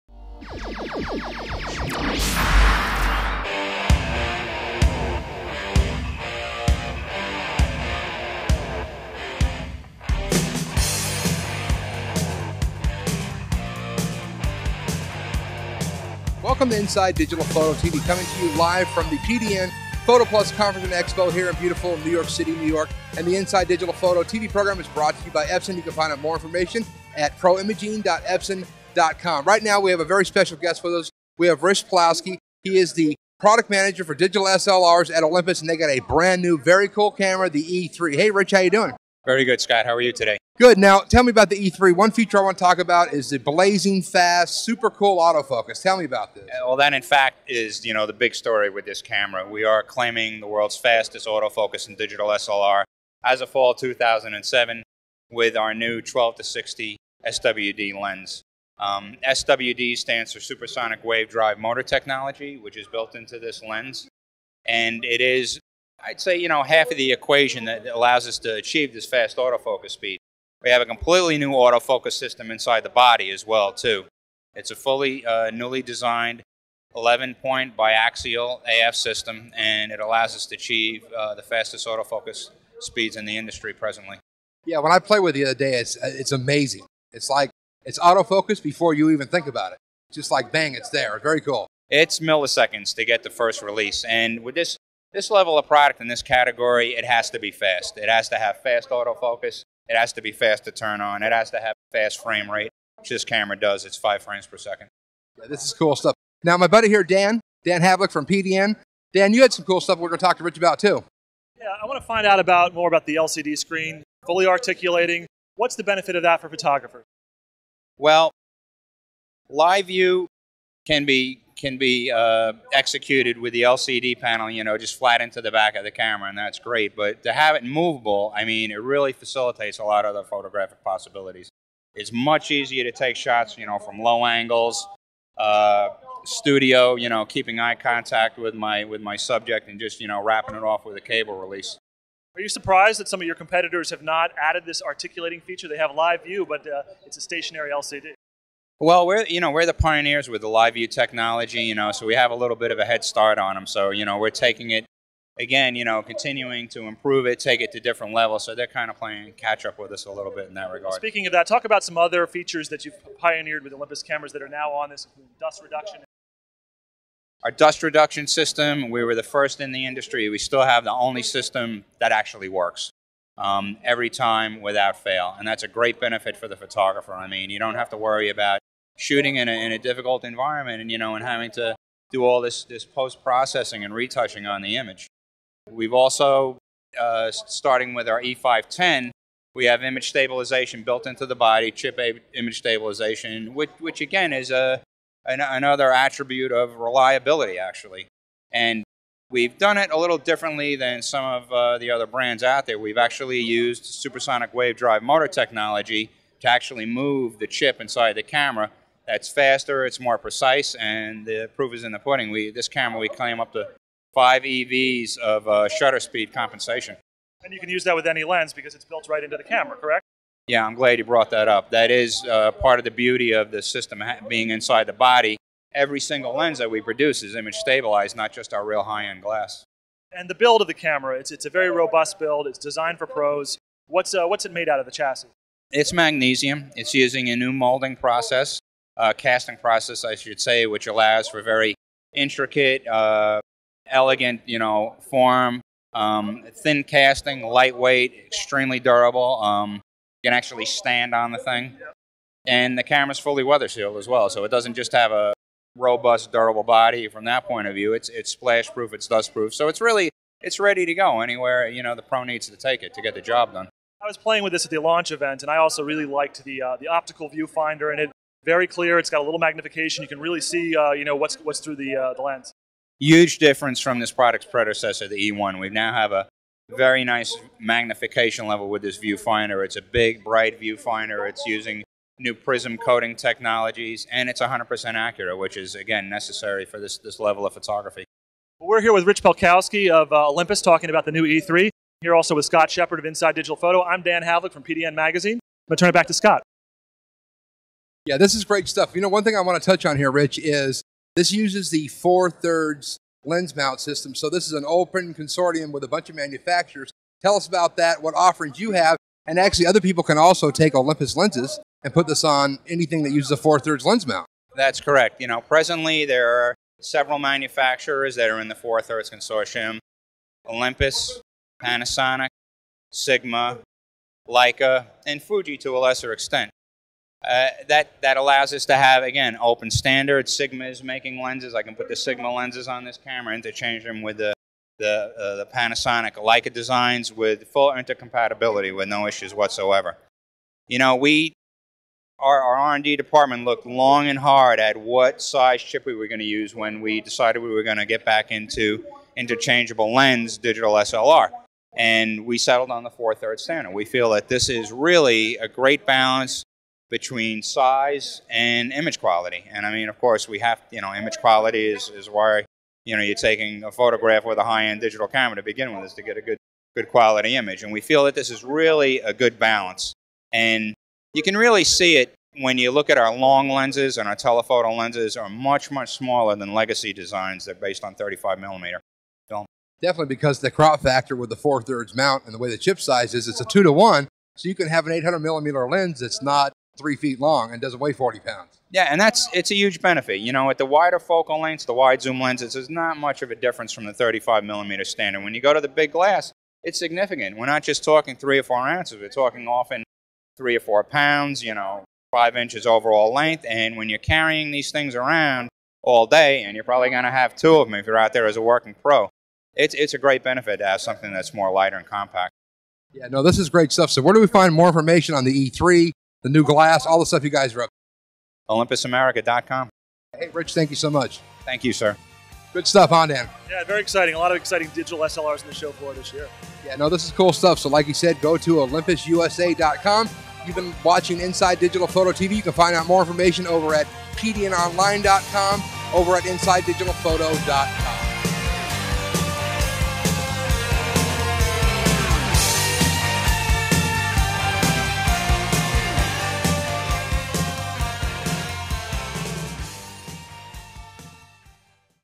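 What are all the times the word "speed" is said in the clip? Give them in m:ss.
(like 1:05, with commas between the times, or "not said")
1:09, 1:22, 3:35.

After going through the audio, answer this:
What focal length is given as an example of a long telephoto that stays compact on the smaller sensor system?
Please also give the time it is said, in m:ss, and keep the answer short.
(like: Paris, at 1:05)
800 millimeter, at 6:24.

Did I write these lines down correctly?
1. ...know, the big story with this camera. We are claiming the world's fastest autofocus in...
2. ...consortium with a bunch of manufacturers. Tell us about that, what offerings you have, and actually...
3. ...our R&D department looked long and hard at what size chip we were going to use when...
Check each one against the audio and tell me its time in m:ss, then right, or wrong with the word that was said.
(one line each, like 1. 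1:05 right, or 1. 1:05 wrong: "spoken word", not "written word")
1. 0:47 right
2. 5:05 right
3. 5:42 right.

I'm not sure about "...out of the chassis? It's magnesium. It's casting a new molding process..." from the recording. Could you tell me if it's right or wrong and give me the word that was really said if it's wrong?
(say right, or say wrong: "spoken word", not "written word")
wrong: "using", not "casting".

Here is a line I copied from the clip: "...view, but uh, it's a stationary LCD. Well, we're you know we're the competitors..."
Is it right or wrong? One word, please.
wrong.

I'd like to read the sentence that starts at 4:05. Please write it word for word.
Um, thin casting, lightweight, extremely durable.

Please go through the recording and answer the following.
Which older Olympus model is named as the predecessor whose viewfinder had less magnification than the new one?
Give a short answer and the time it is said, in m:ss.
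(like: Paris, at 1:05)
E1, at 4:35.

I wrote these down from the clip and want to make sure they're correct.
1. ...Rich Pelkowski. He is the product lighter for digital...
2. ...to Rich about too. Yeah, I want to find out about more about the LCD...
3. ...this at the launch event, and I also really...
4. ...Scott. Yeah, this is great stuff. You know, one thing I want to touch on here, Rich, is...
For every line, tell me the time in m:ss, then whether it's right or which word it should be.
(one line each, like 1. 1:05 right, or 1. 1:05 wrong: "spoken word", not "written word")
1. 0:31 wrong: "manager", not "lighter"
2. 1:50 right
3. 4:24 right
4. 4:56 right.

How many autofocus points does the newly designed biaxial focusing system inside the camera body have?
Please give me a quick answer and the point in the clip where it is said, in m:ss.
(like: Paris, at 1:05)
11, at 1:16.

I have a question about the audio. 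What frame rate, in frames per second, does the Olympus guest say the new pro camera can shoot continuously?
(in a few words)
5.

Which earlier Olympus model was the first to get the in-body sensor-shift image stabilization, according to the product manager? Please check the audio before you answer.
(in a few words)
E510.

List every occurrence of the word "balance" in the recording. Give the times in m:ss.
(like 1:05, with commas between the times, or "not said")
5:55, 6:09.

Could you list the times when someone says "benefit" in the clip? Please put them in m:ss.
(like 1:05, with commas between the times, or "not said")
1:55, 2:55, 6:29, 6:50.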